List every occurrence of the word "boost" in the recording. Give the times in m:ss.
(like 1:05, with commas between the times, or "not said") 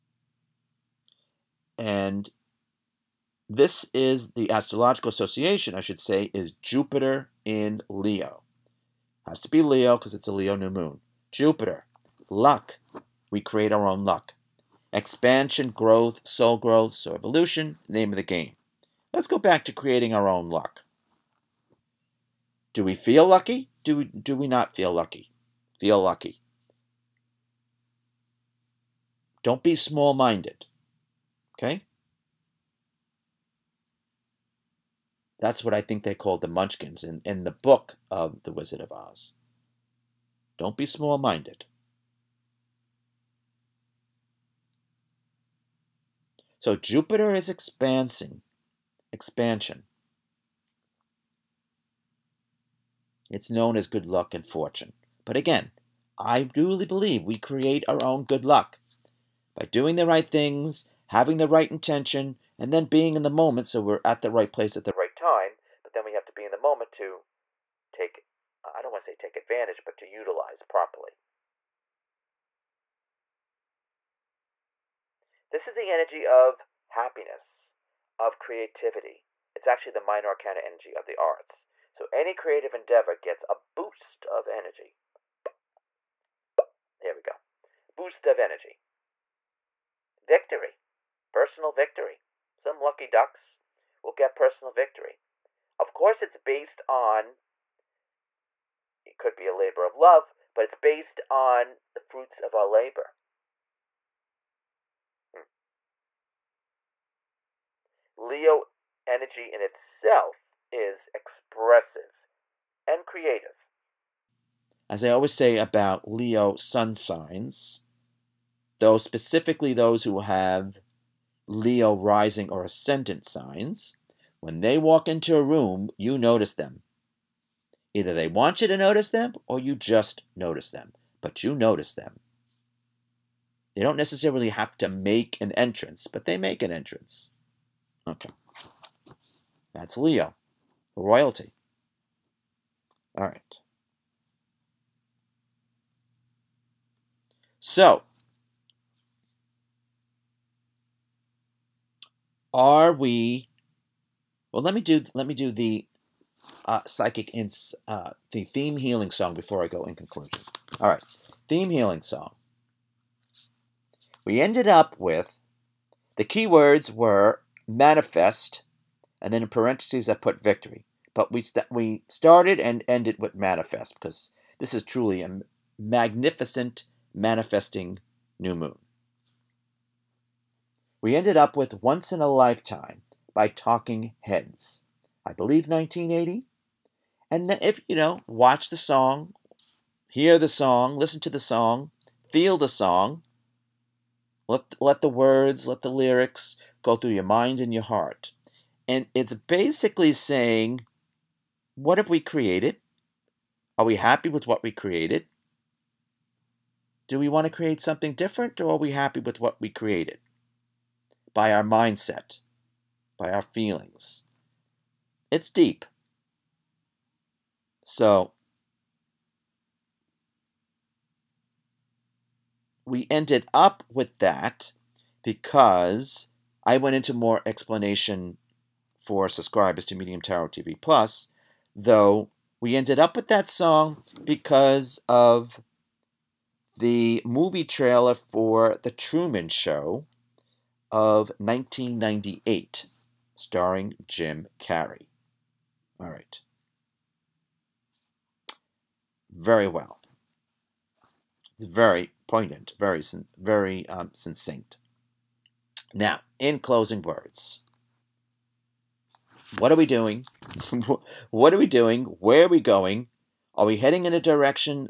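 1:23, 1:27.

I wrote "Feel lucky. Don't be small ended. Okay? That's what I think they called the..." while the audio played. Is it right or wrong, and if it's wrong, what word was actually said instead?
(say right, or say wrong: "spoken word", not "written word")
wrong: "minded", not "ended".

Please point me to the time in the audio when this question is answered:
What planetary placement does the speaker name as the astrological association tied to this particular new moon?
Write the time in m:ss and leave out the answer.
0:06.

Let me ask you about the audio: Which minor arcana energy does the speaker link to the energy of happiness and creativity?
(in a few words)
the arts.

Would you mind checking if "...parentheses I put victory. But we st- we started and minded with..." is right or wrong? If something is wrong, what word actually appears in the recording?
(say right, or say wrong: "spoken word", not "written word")
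wrong: "ended", not "minded".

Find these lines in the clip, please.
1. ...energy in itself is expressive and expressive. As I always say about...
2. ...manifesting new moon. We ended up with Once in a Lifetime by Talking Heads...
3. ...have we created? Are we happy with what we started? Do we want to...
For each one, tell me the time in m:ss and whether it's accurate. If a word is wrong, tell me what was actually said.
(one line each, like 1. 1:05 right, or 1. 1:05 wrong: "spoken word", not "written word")
1. 1:49 wrong: "creative", not "expressive"
2. 2:57 right
3. 3:21 wrong: "created", not "started".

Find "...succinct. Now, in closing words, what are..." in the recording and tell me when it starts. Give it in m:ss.
4:14.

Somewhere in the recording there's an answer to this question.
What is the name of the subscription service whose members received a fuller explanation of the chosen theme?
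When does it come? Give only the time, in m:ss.
3:49.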